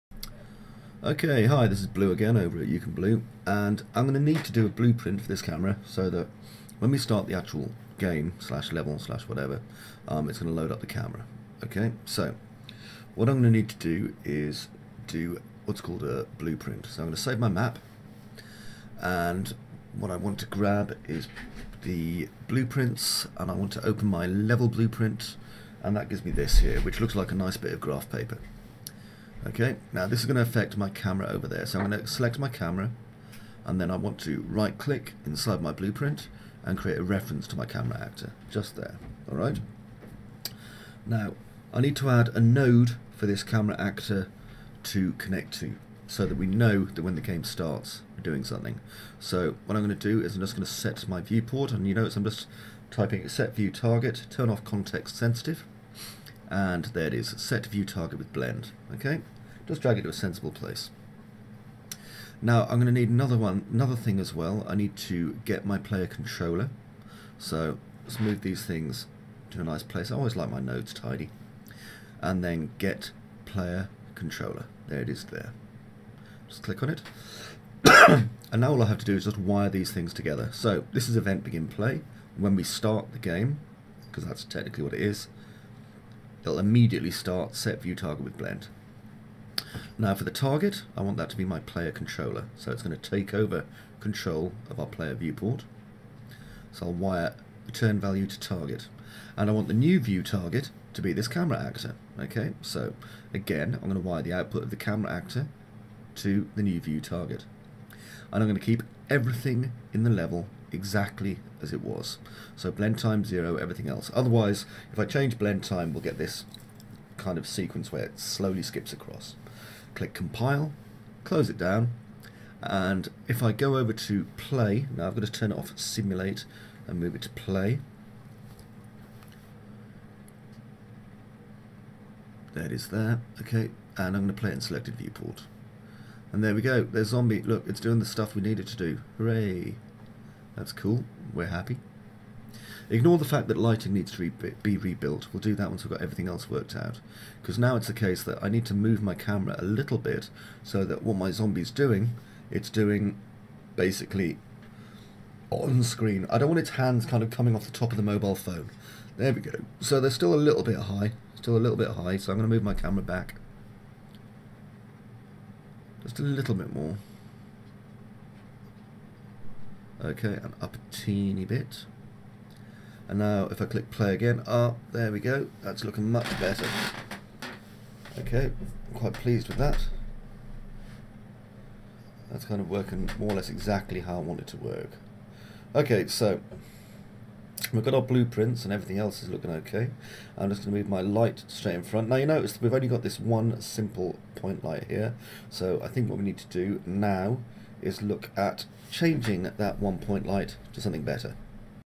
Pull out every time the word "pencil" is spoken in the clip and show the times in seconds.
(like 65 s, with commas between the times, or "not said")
not said.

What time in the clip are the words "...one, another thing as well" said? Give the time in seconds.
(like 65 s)
63 s.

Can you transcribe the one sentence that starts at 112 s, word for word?
So blend time zero, everything else.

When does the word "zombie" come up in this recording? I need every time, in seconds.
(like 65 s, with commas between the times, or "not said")
137 s, 151 s.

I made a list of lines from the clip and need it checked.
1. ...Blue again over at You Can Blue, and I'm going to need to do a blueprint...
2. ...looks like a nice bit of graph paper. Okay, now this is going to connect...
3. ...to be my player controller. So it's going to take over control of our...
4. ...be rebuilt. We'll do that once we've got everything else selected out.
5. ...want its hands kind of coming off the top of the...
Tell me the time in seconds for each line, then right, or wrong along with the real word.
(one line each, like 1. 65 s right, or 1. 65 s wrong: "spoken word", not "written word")
1. 1 s right
2. 27 s wrong: "affect", not "connect"
3. 91 s right
4. 144 s wrong: "worked", not "selected"
5. 156 s right.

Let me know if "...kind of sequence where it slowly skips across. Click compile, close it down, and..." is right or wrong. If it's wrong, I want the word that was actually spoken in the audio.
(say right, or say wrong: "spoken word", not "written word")
right.